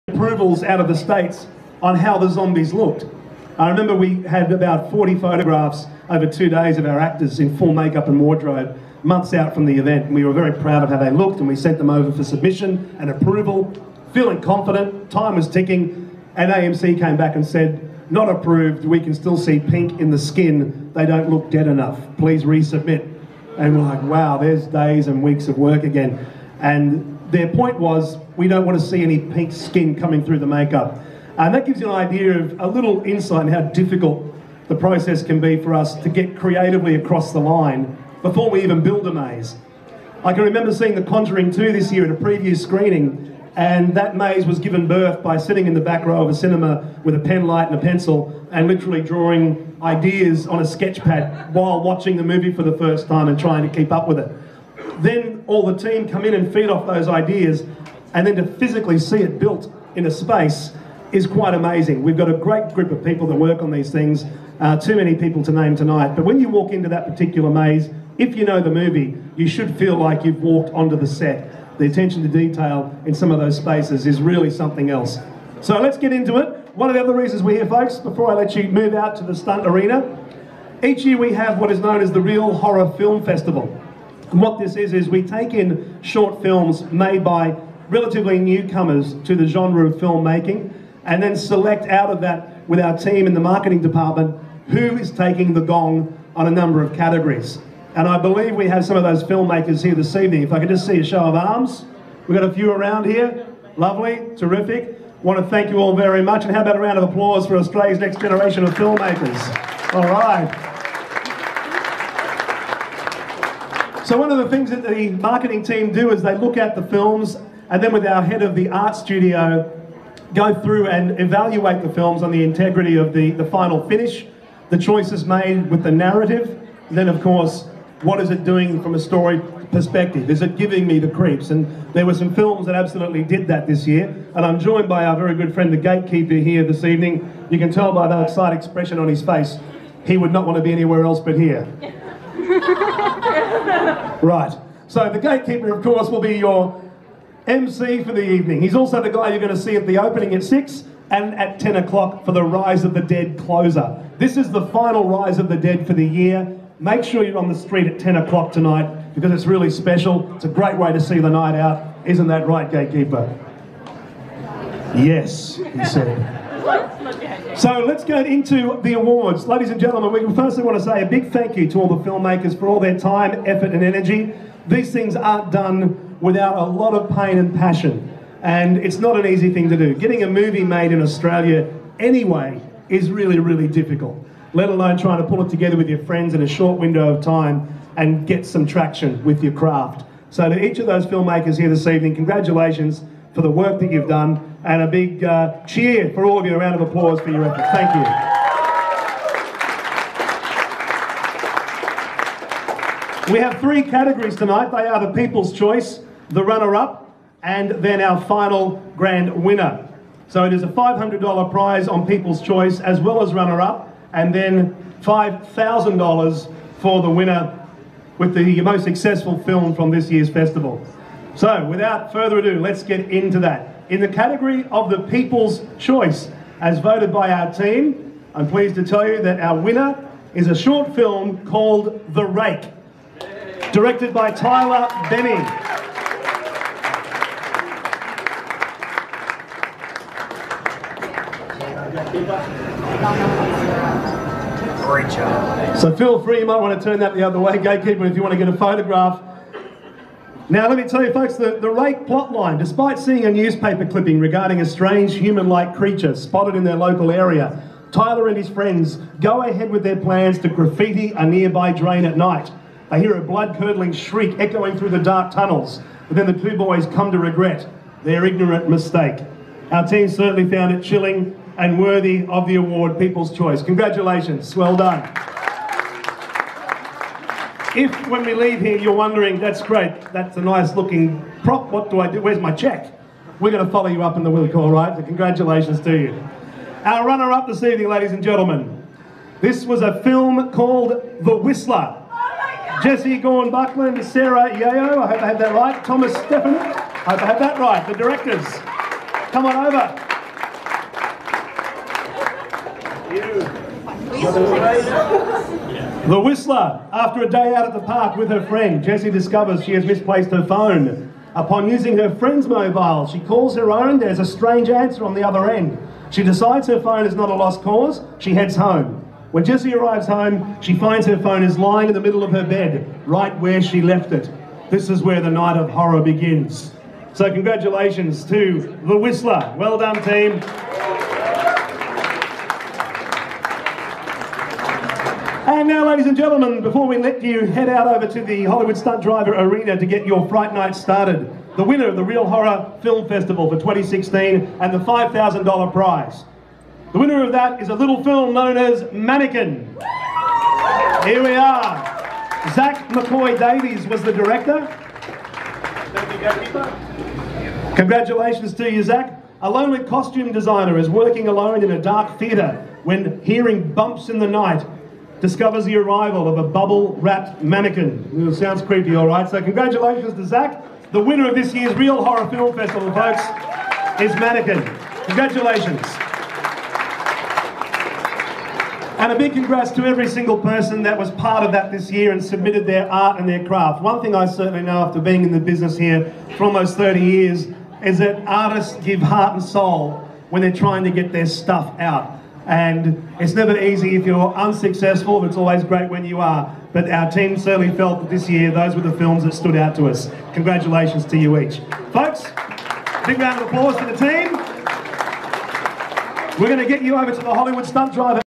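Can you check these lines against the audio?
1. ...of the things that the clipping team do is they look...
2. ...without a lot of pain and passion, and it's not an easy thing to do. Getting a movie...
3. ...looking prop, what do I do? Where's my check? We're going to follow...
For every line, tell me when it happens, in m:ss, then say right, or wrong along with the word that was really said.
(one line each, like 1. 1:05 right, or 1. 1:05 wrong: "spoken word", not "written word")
1. 1:54 wrong: "marketing", not "clipping"
2. 2:56 right
3. 4:40 right.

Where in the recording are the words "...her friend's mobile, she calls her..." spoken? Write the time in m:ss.
5:11.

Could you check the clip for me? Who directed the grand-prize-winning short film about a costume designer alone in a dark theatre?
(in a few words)
Zach McCoy Davies.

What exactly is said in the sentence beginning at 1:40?
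If I could just see a show of arms.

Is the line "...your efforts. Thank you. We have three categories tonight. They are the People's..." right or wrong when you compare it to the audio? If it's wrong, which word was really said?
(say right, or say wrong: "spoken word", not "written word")
right.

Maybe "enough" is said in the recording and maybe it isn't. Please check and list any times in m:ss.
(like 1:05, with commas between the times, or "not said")
0:21.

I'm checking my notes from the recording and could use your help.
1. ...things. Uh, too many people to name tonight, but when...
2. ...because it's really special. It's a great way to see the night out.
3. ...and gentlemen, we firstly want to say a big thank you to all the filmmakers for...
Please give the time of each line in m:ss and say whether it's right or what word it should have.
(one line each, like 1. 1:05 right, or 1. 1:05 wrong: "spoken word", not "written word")
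1. 1:03 right
2. 2:39 right
3. 2:49 right.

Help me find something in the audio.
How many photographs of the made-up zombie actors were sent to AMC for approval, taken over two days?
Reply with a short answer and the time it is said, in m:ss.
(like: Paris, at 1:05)
40, at 0:04.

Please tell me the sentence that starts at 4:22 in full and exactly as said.
They hear a blood curdling shriek echoing through the dark tunnels, but then the two boys come to regret their ignorant mistake.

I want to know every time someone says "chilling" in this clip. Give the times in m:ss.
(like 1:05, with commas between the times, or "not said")
4:30.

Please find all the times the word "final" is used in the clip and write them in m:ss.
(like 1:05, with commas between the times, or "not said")
2:03, 2:34, 3:28.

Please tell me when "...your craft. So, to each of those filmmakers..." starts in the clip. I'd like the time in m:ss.
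3:09.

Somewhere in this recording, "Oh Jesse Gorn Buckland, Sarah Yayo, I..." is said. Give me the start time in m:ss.
4:52.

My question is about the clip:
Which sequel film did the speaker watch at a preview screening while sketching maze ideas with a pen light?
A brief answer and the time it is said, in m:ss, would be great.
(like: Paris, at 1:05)
The Conjuring 2, at 0:40.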